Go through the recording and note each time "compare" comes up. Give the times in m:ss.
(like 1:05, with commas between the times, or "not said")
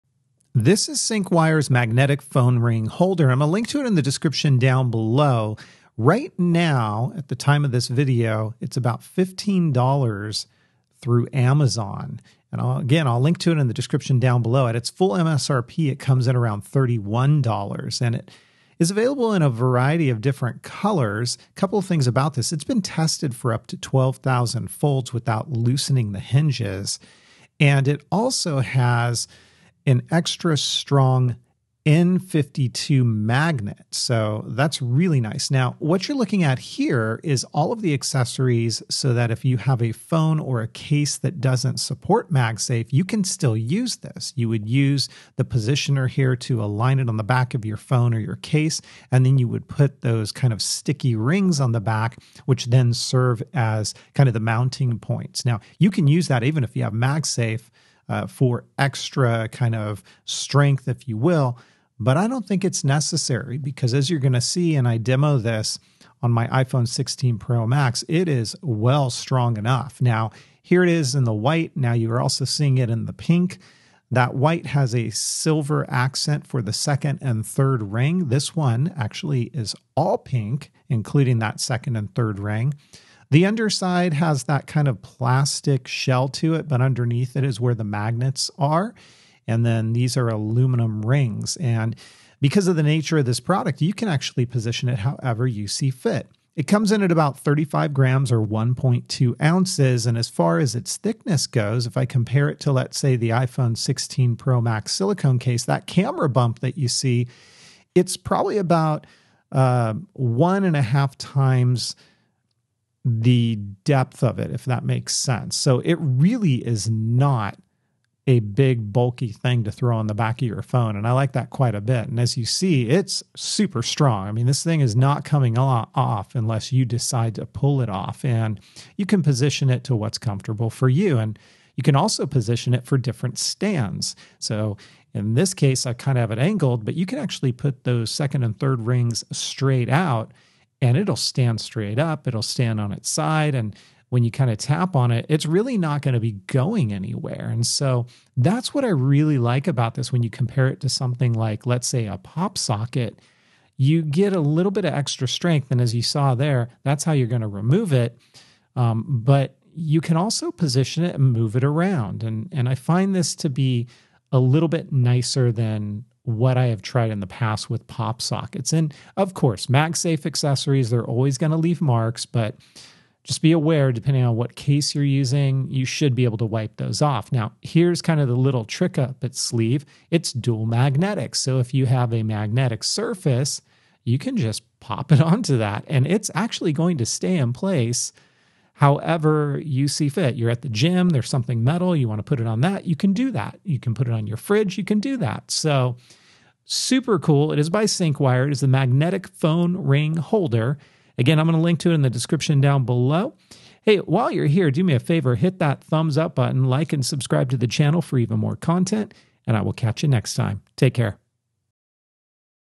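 1:42, 2:30.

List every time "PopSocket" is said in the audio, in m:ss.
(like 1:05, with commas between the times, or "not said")
2:32, 2:47.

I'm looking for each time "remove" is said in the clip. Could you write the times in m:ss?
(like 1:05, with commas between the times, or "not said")
2:37.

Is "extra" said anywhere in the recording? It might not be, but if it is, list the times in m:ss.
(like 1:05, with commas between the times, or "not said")
0:30, 0:58, 2:34.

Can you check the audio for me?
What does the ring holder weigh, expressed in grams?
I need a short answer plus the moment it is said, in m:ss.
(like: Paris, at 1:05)
35 grams, at 1:37.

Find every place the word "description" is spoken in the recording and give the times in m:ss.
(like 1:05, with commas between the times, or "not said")
0:04, 0:13, 3:22.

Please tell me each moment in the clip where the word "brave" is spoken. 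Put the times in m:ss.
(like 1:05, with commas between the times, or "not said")
not said.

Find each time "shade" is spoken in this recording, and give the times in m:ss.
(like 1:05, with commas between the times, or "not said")
not said.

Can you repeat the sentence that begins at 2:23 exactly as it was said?
And when you kind of tap on it, it's really not going to be going anywhere.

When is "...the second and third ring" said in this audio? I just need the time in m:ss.
1:16.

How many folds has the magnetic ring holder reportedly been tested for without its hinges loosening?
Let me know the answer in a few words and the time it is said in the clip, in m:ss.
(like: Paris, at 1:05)
12,000, at 0:23.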